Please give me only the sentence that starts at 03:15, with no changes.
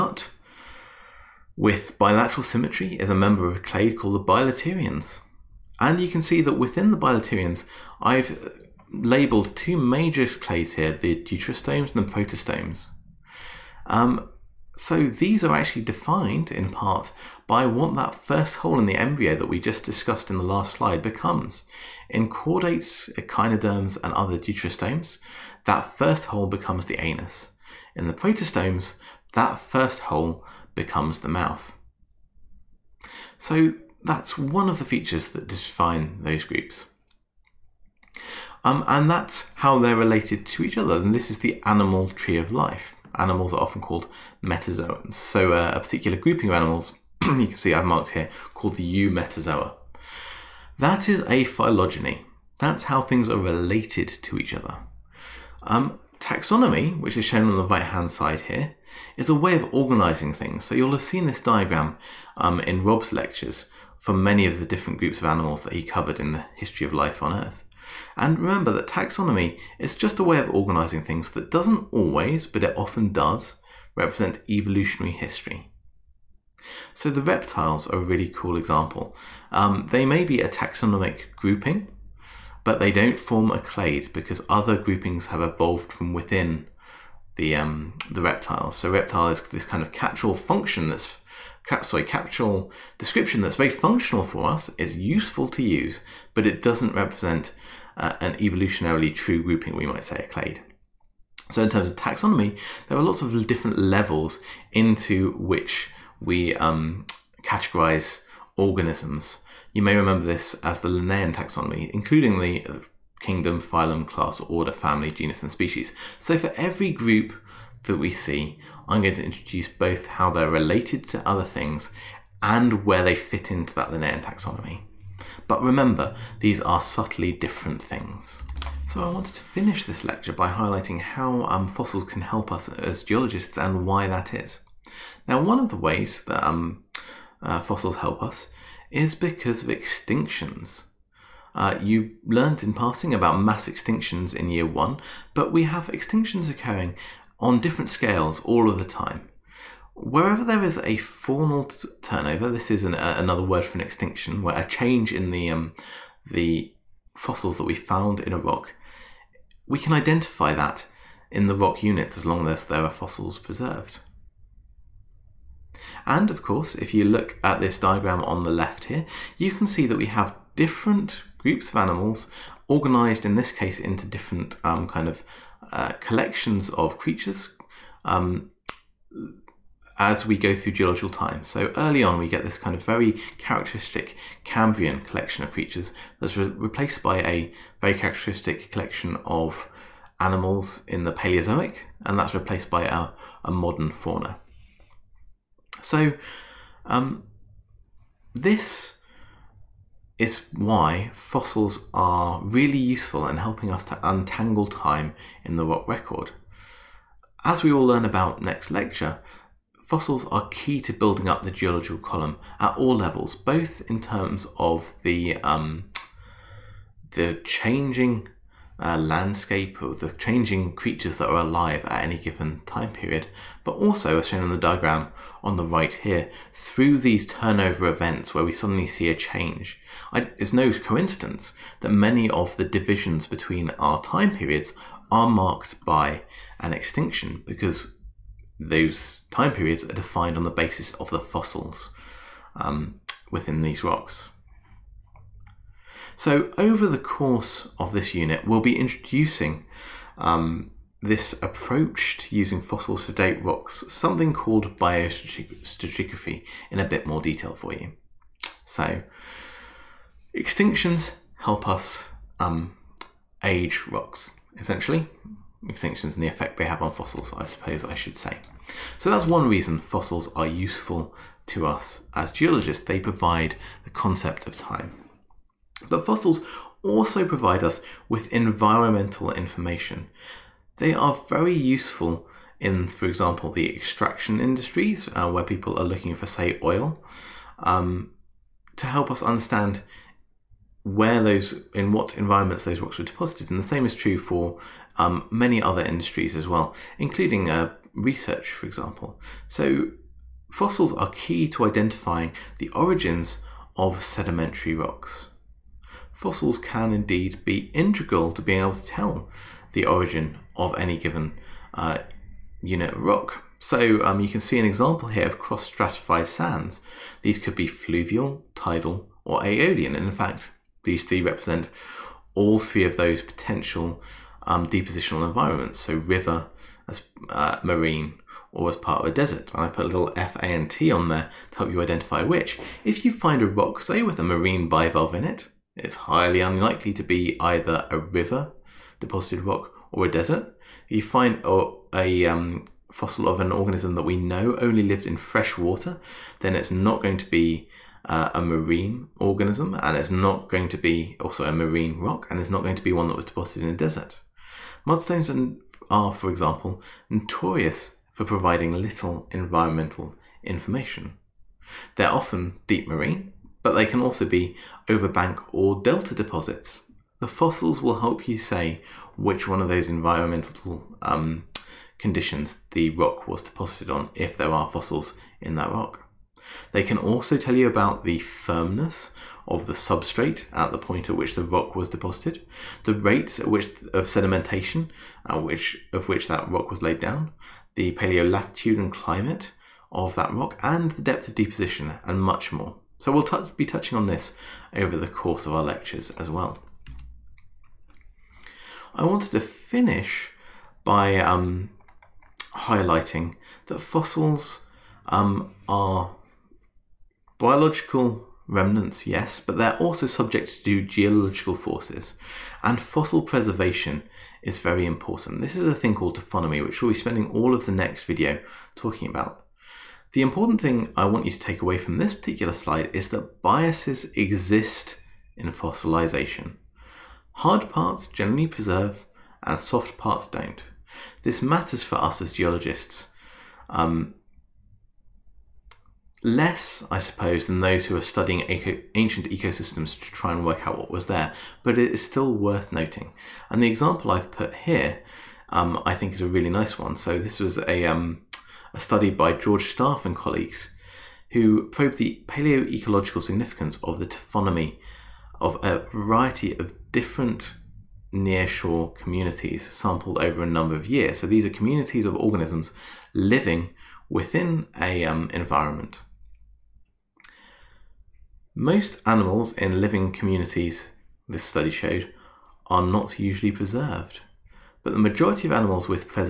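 So um, this is why fossils are really useful in helping us to untangle time in the rock record.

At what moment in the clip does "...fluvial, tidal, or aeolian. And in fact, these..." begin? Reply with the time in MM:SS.
05:17.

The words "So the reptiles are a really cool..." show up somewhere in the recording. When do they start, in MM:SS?
01:16.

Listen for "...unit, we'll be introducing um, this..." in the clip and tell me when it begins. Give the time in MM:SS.
04:08.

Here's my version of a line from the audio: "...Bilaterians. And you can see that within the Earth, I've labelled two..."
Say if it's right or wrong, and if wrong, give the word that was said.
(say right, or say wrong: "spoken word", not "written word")
wrong: "Bilaterians", not "Earth".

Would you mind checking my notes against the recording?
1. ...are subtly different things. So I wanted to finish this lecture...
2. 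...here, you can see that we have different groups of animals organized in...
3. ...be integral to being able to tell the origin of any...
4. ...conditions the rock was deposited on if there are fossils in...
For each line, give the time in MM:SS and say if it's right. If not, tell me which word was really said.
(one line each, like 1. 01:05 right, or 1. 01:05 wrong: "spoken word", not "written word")
1. 02:06 right
2. 02:48 right
3. 05:07 right
4. 06:11 right.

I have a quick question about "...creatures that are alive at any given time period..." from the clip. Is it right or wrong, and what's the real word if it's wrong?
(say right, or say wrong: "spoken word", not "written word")
right.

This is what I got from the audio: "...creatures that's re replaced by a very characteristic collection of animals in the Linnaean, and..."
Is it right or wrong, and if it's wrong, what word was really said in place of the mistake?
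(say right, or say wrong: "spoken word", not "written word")
wrong: "Paleozoic", not "Linnaean".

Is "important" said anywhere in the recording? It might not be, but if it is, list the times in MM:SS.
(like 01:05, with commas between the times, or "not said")
06:54, 07:00.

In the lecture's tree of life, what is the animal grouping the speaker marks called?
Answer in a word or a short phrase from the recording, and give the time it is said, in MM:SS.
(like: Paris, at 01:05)
Eumetazoa, at 00:49.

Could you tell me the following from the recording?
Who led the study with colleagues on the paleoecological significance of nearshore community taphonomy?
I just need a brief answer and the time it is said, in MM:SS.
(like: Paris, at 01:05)
George Staff, at 07:29.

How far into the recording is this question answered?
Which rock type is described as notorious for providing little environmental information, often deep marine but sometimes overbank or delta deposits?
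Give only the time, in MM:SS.
05:54.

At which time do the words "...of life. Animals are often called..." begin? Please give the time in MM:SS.
00:42.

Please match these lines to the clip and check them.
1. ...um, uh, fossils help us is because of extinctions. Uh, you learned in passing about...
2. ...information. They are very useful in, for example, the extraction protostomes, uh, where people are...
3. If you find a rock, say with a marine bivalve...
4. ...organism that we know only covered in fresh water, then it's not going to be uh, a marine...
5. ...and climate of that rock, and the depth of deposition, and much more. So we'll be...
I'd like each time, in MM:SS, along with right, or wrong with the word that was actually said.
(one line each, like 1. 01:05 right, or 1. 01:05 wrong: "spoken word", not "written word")
1. 02:16 right
2. 04:39 wrong: "industries", not "protostomes"
3. 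05:32 right
4. 05:43 wrong: "lived", not "covered"
5. 06:28 right.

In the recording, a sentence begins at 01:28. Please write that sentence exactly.
So reptile is this kind of catch-all function that's sorry capsule description that's very functional for us.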